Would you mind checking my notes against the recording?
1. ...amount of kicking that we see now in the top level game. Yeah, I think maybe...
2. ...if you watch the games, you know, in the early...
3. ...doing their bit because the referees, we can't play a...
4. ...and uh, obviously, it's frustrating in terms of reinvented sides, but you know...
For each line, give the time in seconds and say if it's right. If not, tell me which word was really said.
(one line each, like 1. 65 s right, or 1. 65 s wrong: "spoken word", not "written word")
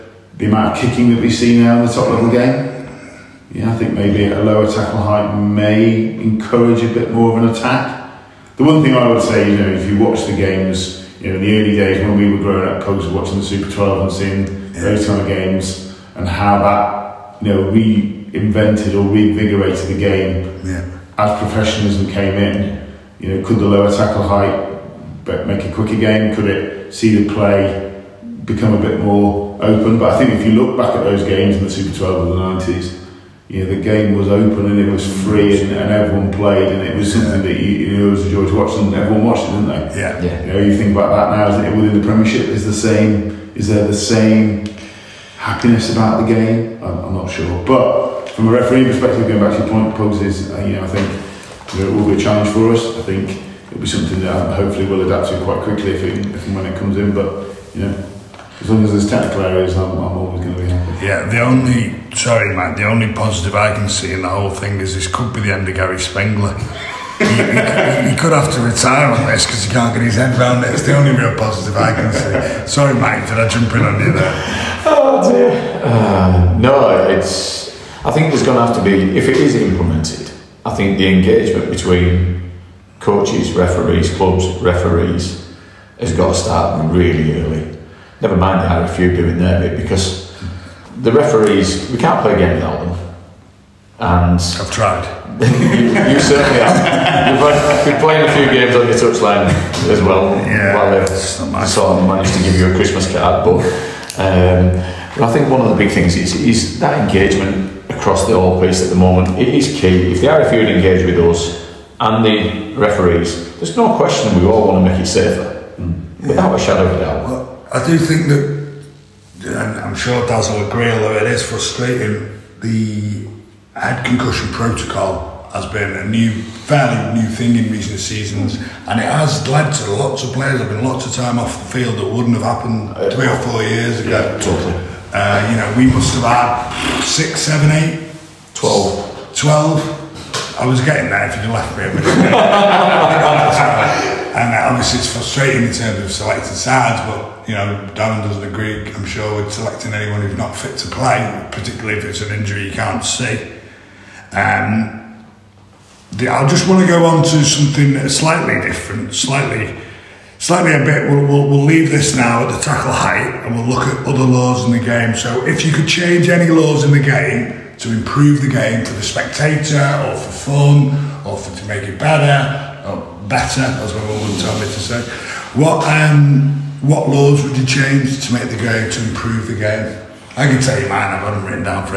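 1. 0 s right
2. 9 s right
3. 89 s right
4. 142 s wrong: "selected", not "reinvented".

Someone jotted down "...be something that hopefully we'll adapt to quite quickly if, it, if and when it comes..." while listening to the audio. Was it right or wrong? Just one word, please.
right.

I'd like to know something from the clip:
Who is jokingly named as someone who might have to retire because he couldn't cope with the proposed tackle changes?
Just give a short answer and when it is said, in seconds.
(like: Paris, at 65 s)
Gary Spengler, at 65 s.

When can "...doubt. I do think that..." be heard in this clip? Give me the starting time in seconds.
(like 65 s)
117 s.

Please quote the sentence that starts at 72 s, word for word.
Sorry, mate, did I jump in on you there?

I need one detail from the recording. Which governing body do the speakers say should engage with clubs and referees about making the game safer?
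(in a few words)
RFU.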